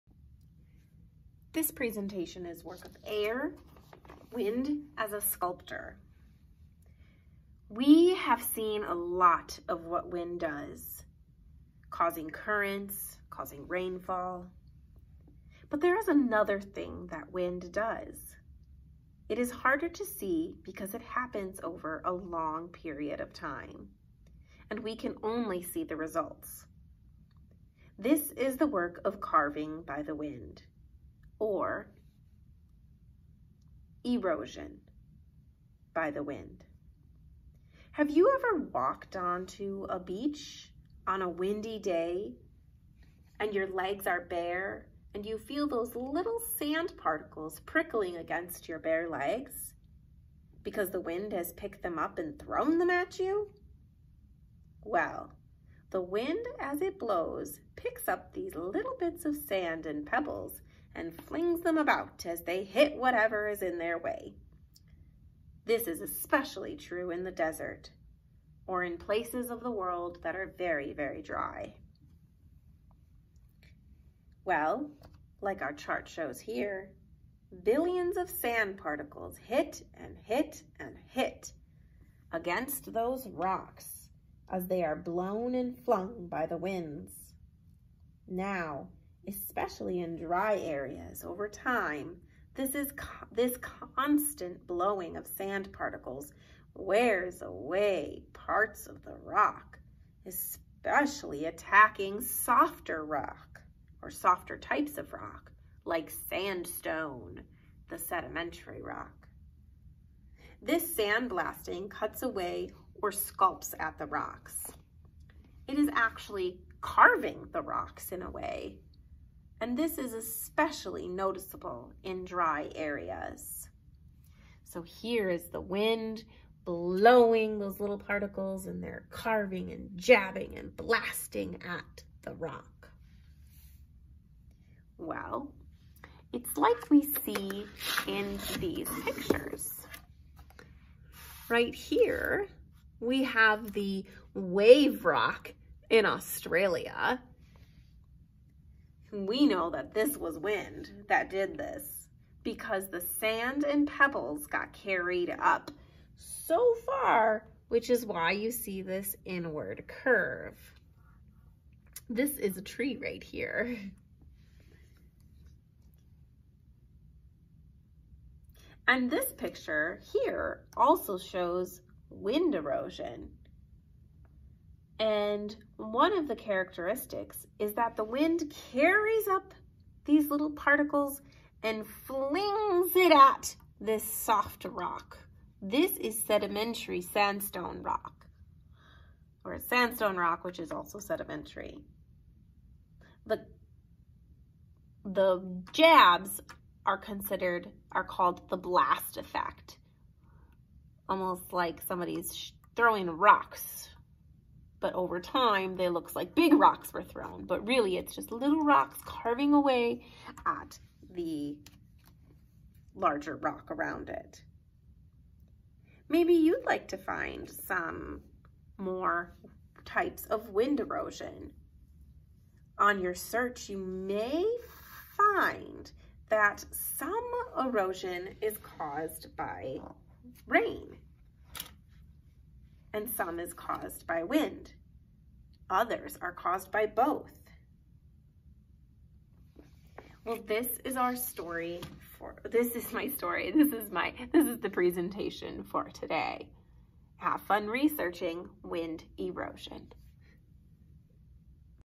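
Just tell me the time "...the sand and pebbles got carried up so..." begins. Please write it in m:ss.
2:32.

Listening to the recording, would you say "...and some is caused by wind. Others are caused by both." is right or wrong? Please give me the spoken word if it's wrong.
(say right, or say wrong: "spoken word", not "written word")
right.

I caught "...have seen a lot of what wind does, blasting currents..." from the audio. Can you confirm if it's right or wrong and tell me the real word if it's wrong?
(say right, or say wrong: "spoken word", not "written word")
wrong: "causing", not "blasting".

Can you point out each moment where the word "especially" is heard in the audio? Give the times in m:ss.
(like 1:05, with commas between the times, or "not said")
1:06, 1:29, 1:40, 2:00.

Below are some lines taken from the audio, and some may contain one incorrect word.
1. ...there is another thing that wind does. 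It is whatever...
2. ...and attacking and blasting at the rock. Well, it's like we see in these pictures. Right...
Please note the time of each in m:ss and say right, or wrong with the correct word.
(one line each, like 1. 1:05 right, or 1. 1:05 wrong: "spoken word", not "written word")
1. 0:15 wrong: "harder", not "whatever"
2. 2:09 wrong: "jabbing", not "attacking".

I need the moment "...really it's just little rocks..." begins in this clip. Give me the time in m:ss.
3:27.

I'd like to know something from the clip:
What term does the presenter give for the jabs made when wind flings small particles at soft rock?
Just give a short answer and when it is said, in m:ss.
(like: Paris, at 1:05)
blast effect, at 3:18.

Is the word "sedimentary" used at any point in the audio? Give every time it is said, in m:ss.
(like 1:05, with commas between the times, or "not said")
1:47, 3:06, 3:10.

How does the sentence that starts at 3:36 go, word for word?
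Maybe you'd like to find some more types of wind erosion.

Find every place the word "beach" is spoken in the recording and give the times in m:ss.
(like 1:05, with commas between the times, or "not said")
0:39.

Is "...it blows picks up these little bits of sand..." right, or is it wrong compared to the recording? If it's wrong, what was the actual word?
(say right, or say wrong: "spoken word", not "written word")
right.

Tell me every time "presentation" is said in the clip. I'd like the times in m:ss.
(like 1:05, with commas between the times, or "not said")
0:01, 4:04.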